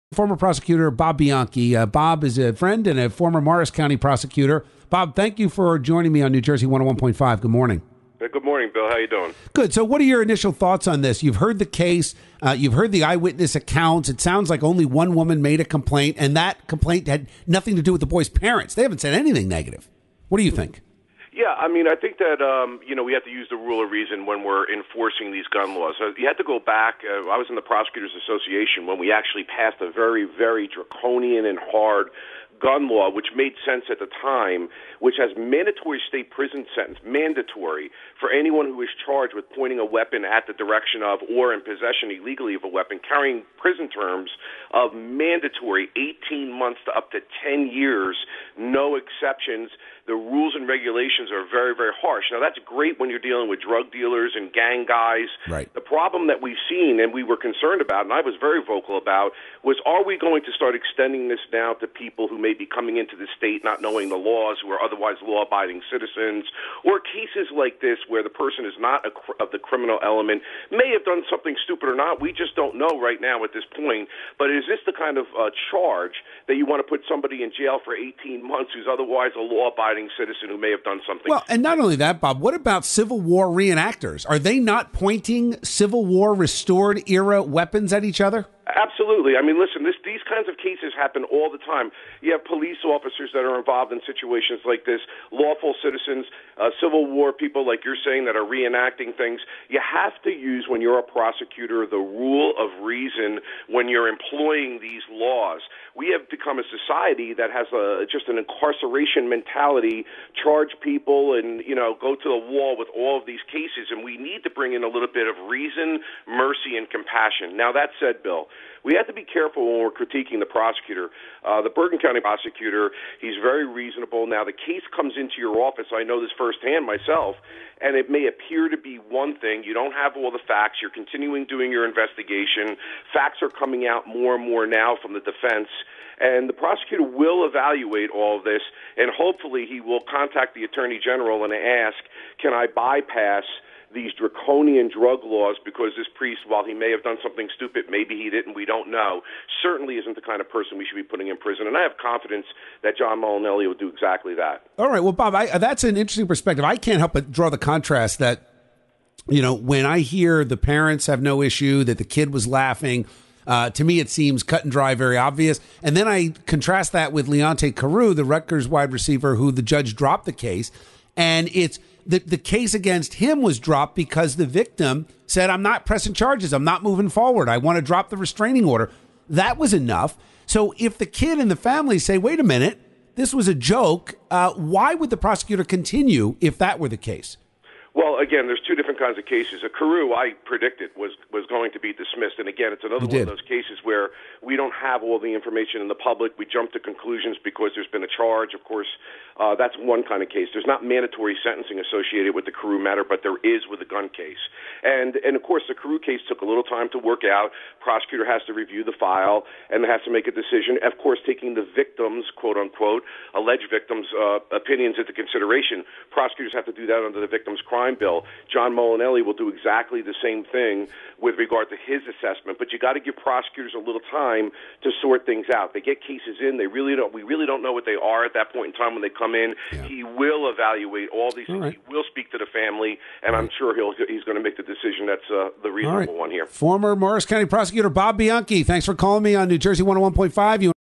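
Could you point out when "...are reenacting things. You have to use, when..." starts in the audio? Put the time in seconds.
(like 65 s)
98 s.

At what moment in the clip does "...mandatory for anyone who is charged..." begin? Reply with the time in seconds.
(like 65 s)
37 s.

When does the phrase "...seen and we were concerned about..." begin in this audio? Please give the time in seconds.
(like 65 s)
56 s.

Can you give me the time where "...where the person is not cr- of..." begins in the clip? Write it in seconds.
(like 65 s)
68 s.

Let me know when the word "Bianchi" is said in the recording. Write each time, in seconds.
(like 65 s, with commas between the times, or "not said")
1 s, 238 s.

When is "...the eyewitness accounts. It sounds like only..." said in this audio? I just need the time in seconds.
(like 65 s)
12 s.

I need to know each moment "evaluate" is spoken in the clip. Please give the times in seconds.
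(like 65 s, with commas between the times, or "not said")
137 s, 230 s.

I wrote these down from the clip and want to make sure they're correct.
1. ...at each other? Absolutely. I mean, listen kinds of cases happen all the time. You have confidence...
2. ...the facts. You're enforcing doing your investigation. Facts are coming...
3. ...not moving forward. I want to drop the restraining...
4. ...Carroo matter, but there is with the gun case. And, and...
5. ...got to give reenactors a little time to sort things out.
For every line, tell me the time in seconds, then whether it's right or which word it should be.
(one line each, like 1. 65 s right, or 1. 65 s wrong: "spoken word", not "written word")
1. 87 s wrong: "police", not "confidence"
2. 130 s wrong: "continuing", not "enforcing"
3. 176 s right
4. 202 s right
5. 222 s wrong: "prosecutors", not "reenactors".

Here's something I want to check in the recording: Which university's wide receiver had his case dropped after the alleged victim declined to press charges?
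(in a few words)
Rutgers.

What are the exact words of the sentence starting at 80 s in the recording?
law-abiding citizen who may have done something.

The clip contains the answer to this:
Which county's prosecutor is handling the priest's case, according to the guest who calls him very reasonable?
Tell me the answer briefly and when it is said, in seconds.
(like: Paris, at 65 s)
Bergen County, at 121 s.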